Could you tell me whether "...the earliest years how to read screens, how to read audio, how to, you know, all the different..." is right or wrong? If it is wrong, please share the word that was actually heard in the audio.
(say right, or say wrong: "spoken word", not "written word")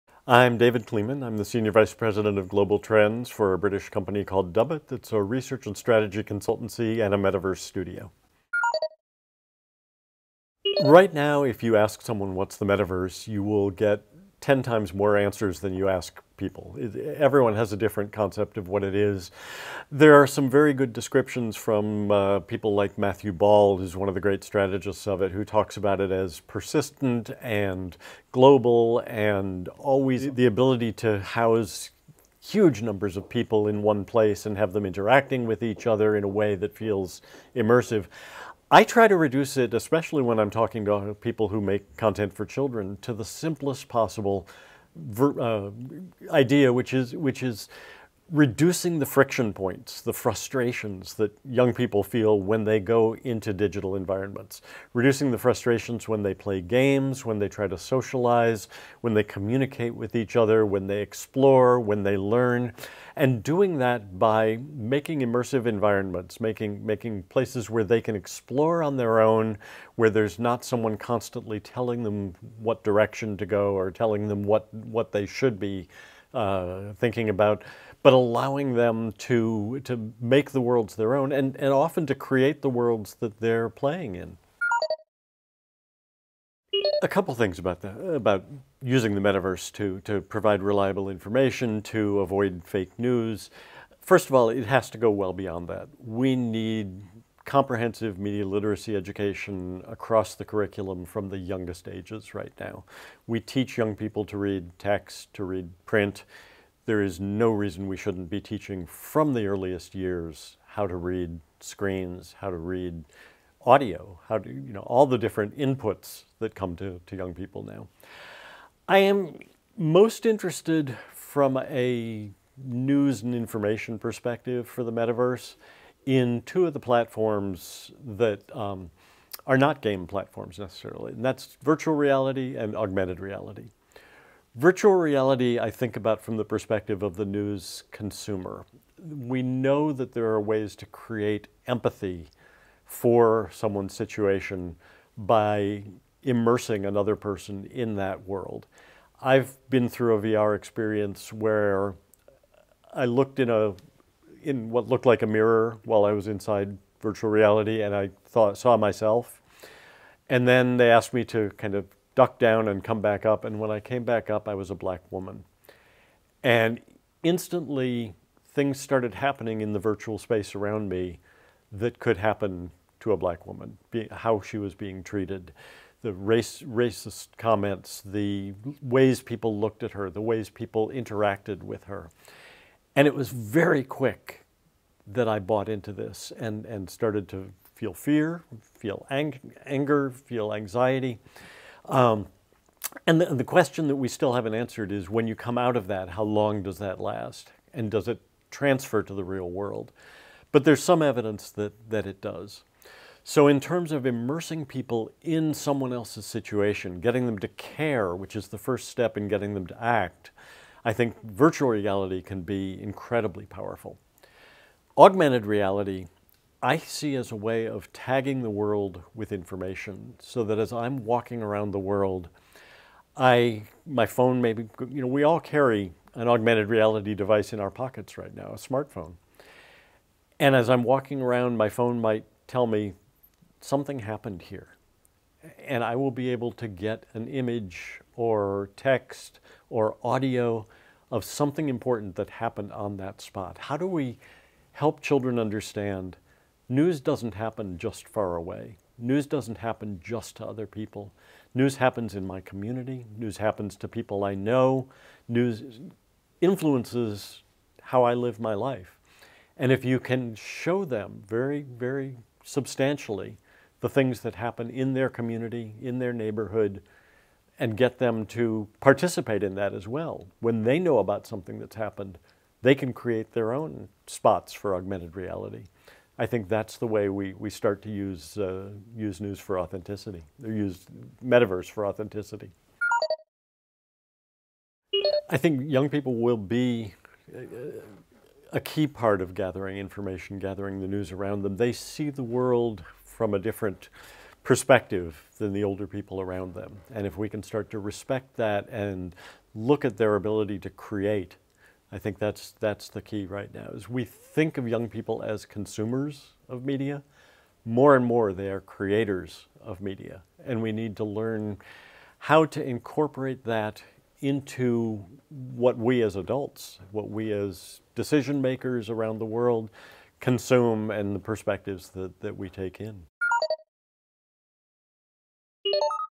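right.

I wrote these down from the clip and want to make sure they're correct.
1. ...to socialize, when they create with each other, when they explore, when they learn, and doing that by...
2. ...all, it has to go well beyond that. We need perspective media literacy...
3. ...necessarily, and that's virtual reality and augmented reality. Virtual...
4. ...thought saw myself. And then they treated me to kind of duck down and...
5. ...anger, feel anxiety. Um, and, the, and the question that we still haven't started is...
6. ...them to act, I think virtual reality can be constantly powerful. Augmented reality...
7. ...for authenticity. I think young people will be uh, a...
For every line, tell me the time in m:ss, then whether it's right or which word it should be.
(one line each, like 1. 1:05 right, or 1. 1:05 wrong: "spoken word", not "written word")
1. 0:57 wrong: "communicate", not "create"
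2. 1:34 wrong: "comprehensive", not "perspective"
3. 2:10 right
4. 2:38 wrong: "asked", not "treated"
5. 3:09 wrong: "answered", not "started"
6. 3:29 wrong: "incredibly", not "constantly"
7. 4:41 right.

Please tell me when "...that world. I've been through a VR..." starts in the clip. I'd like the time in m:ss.
2:27.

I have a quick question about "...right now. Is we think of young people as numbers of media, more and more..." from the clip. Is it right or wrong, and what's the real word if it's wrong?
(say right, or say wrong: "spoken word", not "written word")
wrong: "consumers", not "numbers".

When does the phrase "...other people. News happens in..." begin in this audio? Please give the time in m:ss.
4:10.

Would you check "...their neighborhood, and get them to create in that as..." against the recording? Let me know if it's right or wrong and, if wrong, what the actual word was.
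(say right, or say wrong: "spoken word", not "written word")
wrong: "participate", not "create".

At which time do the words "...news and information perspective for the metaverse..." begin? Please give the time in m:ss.
2:02.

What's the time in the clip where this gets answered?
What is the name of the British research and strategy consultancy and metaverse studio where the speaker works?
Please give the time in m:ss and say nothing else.
0:04.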